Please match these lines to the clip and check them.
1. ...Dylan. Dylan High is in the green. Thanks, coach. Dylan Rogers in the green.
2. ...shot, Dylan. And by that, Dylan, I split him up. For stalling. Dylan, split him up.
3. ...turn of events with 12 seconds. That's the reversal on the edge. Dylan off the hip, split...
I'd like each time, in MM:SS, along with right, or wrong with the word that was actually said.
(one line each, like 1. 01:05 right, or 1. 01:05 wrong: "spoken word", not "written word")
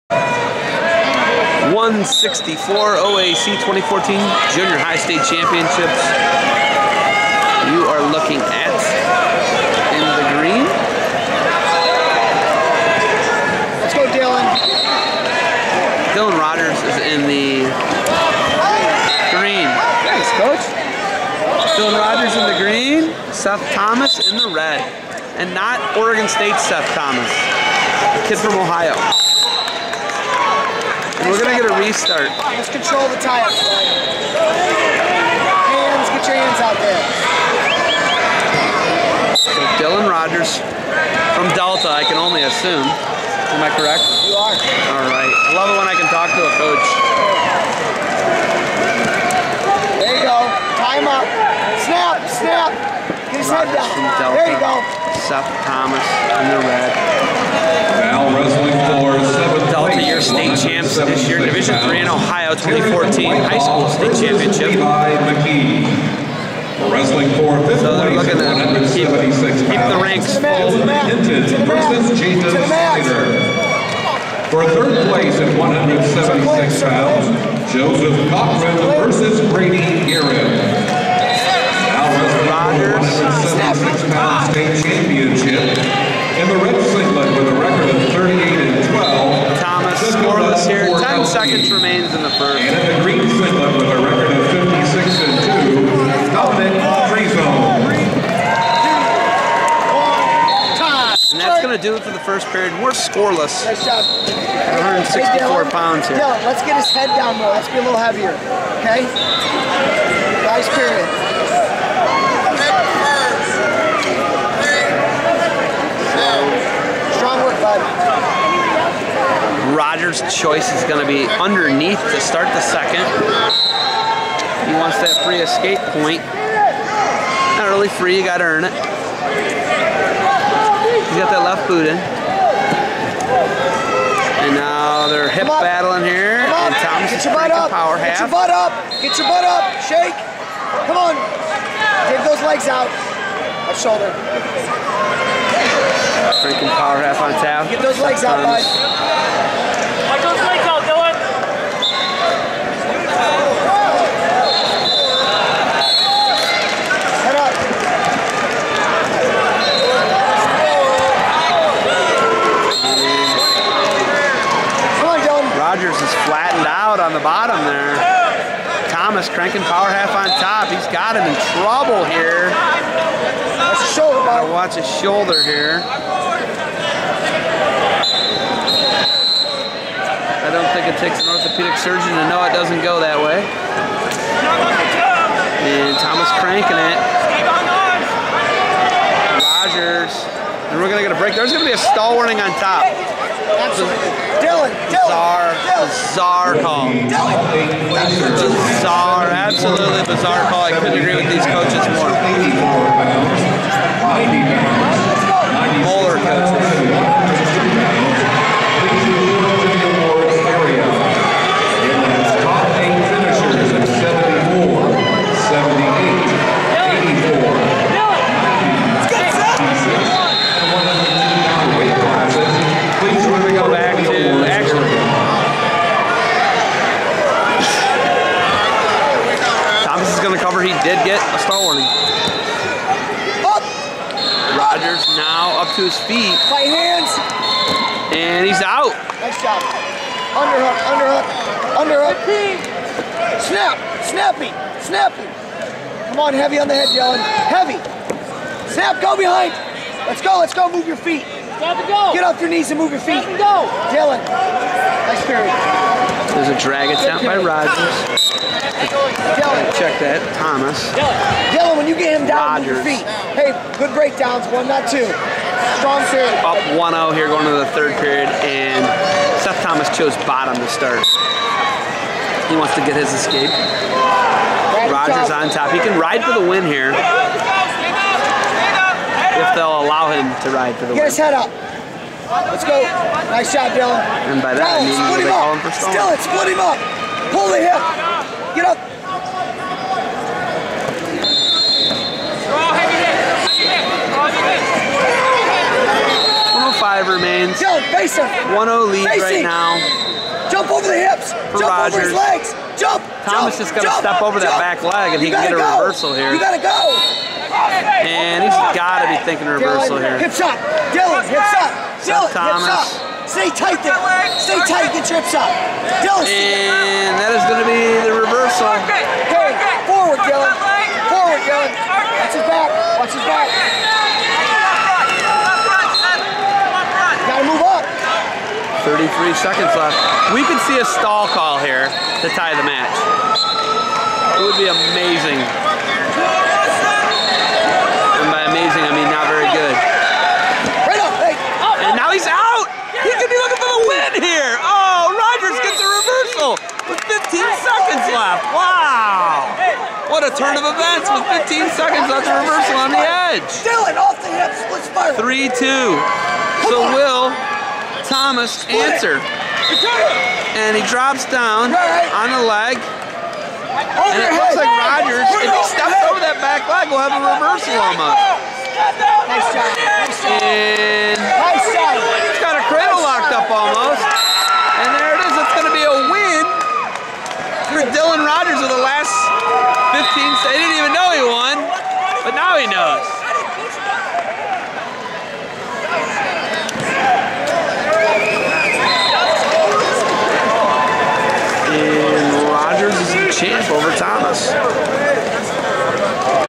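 1. 00:14 wrong: "Rogers", not "High"
2. 04:43 right
3. 05:50 wrong: "15", not "12".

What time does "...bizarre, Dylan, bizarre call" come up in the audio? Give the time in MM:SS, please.
03:14.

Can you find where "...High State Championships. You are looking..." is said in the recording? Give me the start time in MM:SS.
00:04.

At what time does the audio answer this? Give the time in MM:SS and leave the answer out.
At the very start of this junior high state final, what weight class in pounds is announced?
00:01.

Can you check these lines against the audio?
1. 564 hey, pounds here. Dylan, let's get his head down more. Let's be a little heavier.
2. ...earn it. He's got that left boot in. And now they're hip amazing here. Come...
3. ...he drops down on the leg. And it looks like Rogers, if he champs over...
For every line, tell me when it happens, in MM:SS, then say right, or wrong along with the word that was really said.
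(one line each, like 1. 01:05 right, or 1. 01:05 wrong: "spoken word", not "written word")
1. 01:44 wrong: "164", not "564"
2. 02:08 wrong: "battling", not "amazing"
3. 06:00 wrong: "steps", not "champs".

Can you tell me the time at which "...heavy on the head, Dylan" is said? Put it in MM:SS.
04:06.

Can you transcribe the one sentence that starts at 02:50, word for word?
He's got him in trouble here.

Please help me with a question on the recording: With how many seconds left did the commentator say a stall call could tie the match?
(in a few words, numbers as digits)
33.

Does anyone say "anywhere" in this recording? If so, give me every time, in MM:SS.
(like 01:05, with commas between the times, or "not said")
not said.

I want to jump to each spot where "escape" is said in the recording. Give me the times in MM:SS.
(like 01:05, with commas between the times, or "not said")
02:05, 04:33.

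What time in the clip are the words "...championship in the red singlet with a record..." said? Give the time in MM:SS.
01:24.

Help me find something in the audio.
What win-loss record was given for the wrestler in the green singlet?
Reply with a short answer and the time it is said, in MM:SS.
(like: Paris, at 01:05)
56 and 2, at 01:34.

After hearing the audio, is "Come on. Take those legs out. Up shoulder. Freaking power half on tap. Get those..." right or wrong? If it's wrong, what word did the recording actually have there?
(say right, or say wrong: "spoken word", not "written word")
right.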